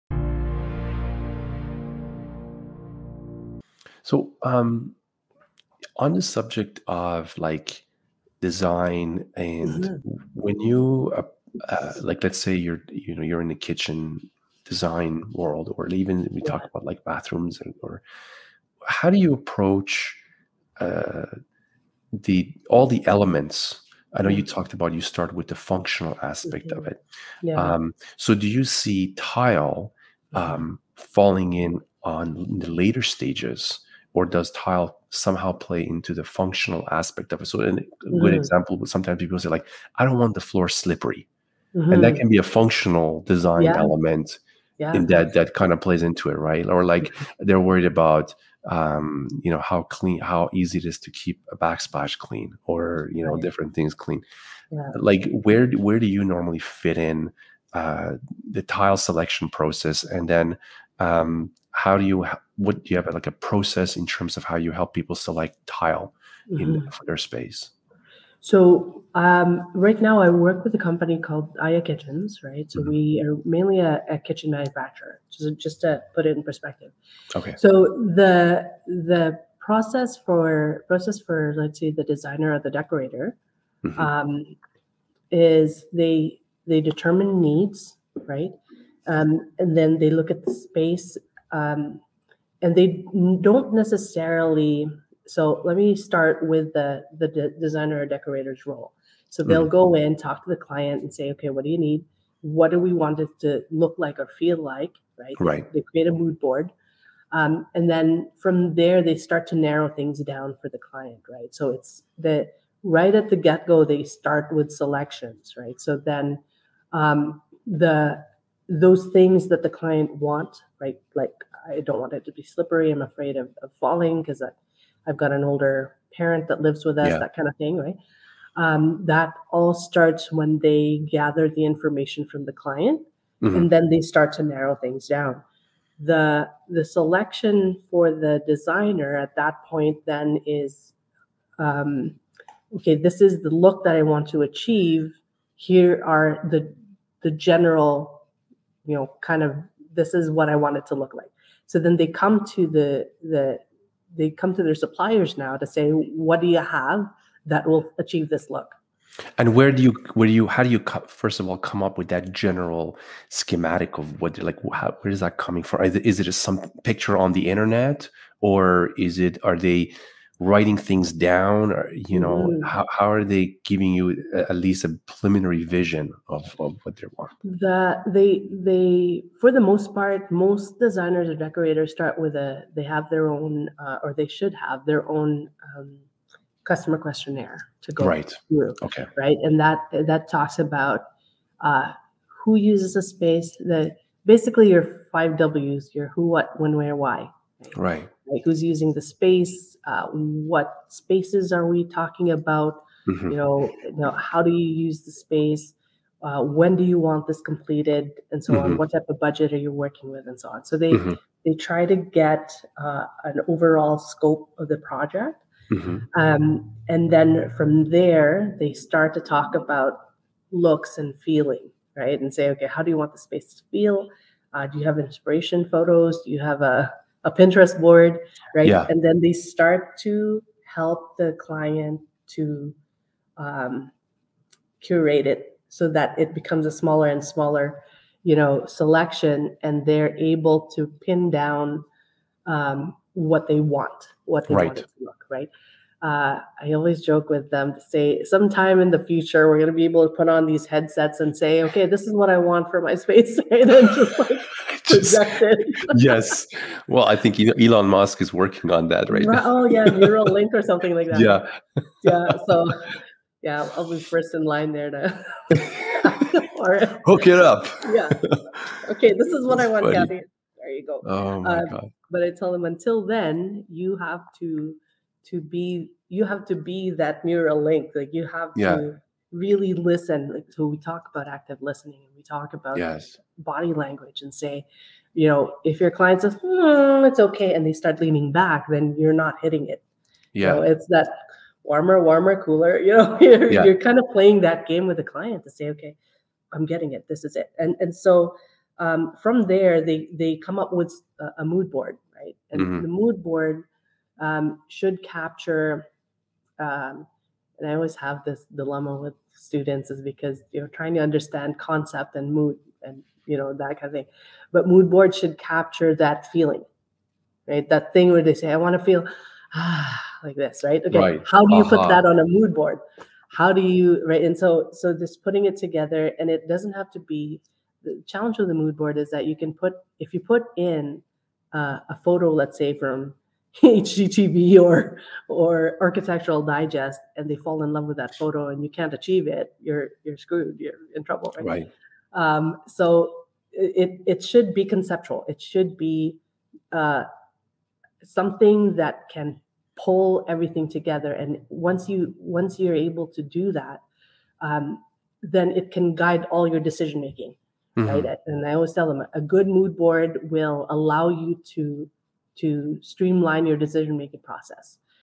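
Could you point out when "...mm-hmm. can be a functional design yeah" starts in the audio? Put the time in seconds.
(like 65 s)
42 s.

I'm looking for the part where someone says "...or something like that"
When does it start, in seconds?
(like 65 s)
260 s.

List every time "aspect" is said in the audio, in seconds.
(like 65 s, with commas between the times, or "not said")
26 s, 36 s.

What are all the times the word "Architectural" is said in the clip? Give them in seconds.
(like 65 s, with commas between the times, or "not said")
335 s.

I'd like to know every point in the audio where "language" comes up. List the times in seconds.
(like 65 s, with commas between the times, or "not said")
283 s.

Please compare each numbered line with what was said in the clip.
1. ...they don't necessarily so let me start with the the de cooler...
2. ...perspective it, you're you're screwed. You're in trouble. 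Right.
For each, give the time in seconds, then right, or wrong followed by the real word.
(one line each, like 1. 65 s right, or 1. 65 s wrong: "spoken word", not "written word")
1. 92 s wrong: "designer", not "cooler"
2. 338 s wrong: "achieve", not "perspective".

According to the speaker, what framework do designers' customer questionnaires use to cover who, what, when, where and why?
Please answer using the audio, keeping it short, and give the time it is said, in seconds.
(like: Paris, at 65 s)
five W's, at 195 s.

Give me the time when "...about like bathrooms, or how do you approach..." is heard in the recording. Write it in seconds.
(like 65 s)
16 s.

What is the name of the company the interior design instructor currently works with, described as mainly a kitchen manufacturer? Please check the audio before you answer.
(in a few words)
Aya Kitchens.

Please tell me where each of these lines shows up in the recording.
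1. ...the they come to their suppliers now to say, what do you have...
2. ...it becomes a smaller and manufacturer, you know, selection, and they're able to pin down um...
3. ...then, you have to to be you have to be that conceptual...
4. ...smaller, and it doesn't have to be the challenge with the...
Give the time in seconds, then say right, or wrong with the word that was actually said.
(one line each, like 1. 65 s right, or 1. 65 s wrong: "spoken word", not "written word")
1. 153 s right
2. 236 s wrong: "smaller", not "manufacturer"
3. 273 s wrong: "neural", not "conceptual"
4. 325 s wrong: "together", not "smaller".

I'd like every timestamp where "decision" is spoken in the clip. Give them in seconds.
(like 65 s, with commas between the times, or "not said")
356 s, 363 s.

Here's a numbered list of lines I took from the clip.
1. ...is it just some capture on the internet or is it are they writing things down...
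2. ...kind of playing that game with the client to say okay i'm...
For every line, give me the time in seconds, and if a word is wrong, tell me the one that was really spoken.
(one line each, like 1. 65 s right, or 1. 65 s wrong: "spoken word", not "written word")
1. 166 s wrong: "picture", not "capture"
2. 293 s right.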